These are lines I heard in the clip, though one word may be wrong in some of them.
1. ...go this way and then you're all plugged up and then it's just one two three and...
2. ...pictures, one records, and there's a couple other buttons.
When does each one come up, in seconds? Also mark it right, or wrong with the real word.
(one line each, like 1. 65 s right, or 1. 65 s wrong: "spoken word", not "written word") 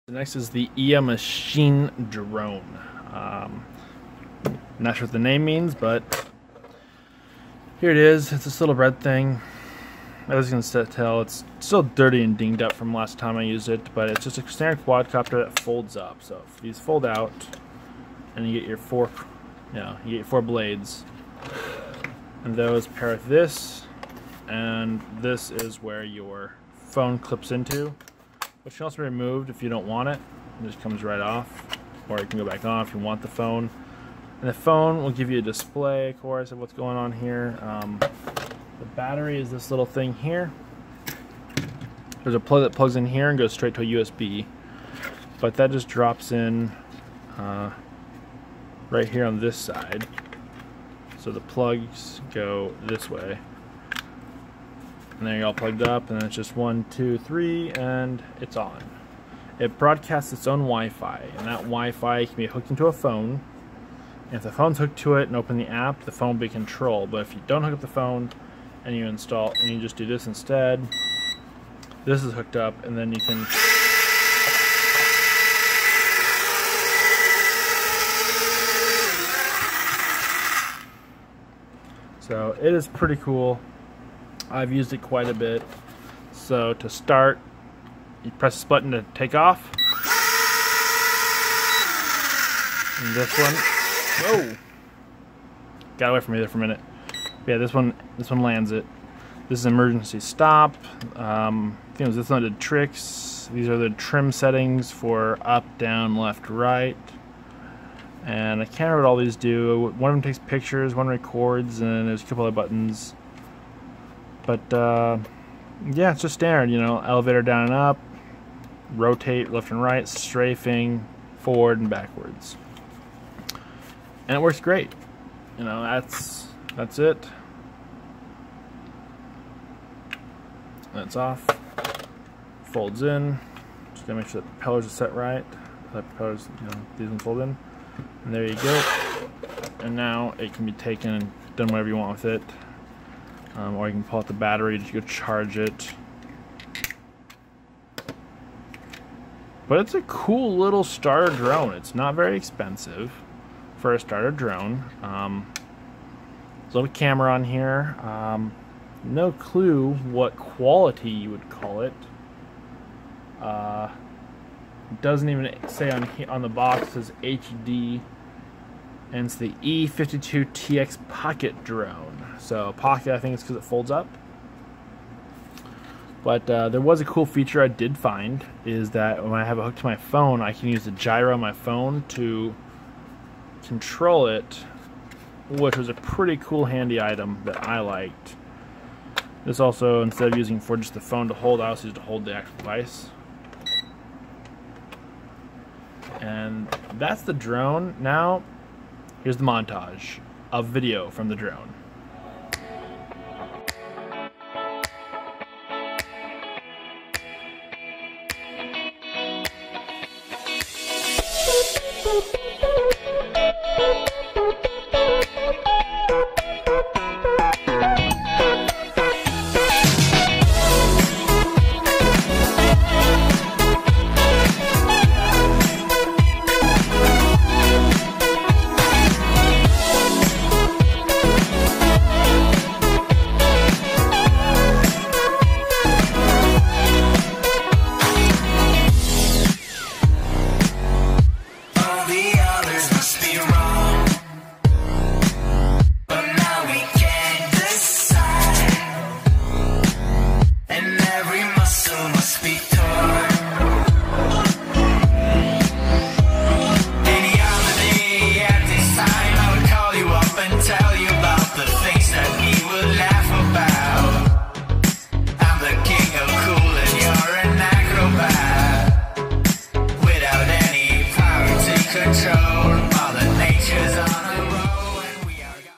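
1. 52 s right
2. 110 s right.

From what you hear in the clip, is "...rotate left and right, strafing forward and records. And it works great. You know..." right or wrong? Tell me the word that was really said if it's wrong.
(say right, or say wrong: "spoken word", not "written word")
wrong: "backwards", not "records".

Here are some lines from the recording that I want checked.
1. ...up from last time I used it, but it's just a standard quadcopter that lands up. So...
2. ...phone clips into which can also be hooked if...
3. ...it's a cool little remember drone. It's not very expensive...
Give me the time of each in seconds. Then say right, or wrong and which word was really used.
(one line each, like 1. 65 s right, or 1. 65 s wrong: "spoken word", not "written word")
1. 12 s wrong: "folds", not "lands"
2. 26 s wrong: "removed", not "hooked"
3. 149 s wrong: "starter", not "remember".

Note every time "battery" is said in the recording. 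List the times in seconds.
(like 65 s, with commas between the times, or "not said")
38 s, 144 s.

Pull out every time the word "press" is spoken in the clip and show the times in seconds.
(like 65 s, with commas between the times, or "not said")
88 s.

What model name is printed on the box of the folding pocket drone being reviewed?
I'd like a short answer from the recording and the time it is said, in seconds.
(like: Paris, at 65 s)
E52TX Pocket Drone, at 169 s.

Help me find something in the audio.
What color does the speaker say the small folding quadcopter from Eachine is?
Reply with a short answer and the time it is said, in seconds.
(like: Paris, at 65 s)
Red, at 8 s.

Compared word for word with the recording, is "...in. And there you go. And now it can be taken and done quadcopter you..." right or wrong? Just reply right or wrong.
wrong.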